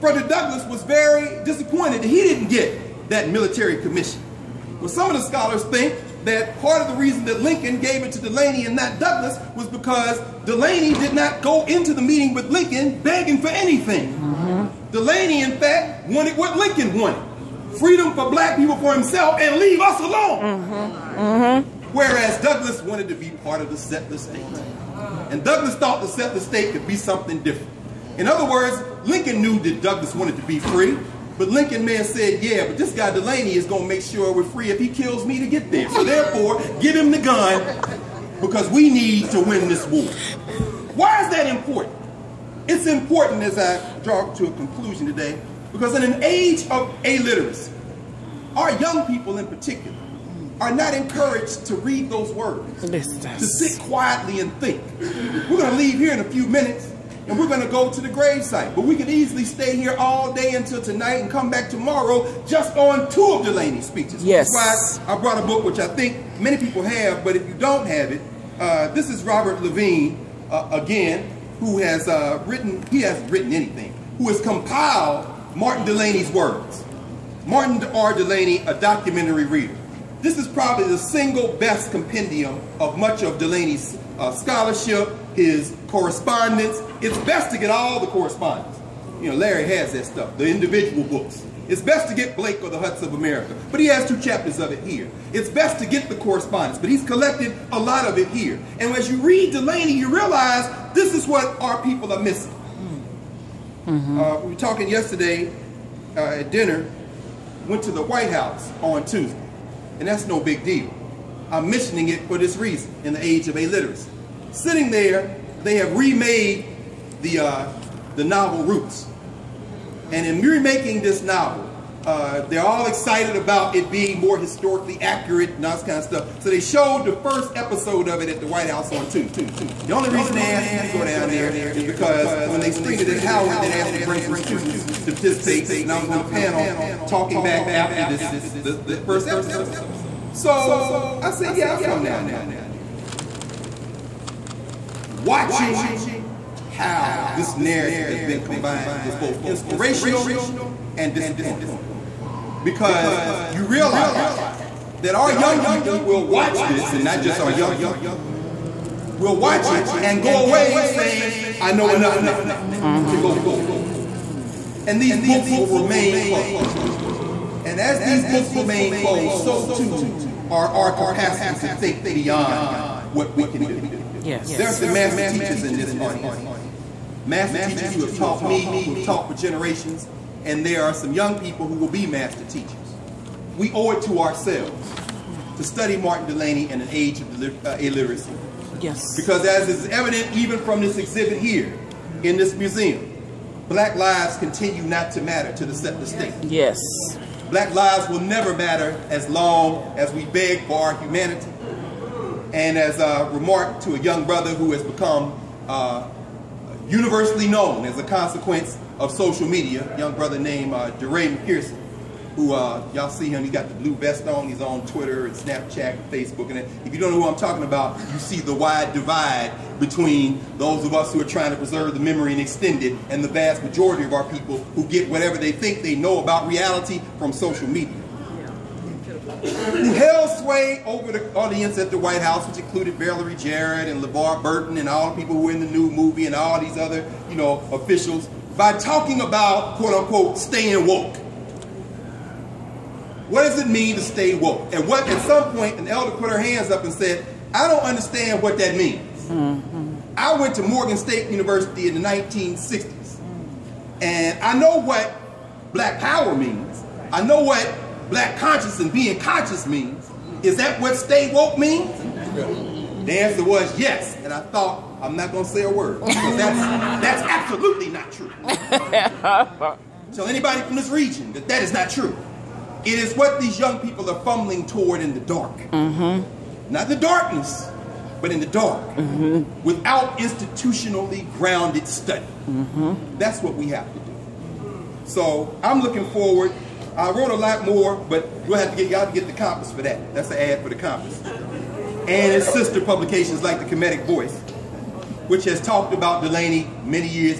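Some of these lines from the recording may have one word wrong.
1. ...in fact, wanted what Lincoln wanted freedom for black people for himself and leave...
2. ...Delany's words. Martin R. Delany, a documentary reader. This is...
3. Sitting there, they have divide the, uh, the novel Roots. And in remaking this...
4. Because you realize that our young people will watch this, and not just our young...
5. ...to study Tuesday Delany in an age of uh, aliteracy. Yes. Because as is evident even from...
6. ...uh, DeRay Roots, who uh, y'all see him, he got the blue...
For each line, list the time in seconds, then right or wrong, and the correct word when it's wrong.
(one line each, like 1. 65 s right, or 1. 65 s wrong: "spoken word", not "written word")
1. 15 s right
2. 75 s right
3. 114 s wrong: "remade", not "divide"
4. 152 s right
5. 185 s wrong: "Martin", not "Tuesday"
6. 210 s wrong: "Mckesson", not "Roots".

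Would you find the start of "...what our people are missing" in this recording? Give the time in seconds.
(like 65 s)
101 s.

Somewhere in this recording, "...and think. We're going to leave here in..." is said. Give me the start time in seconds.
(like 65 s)
54 s.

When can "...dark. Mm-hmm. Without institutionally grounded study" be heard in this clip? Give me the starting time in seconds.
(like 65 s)
278 s.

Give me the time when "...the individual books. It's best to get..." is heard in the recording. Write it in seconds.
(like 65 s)
90 s.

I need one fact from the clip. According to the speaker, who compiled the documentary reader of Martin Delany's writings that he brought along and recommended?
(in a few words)
Robert Levine.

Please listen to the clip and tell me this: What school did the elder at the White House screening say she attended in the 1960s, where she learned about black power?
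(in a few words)
Morgan State University.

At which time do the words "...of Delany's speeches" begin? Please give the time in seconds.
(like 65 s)
63 s.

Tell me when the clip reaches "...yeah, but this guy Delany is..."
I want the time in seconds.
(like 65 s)
32 s.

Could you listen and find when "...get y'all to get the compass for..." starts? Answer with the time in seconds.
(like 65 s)
288 s.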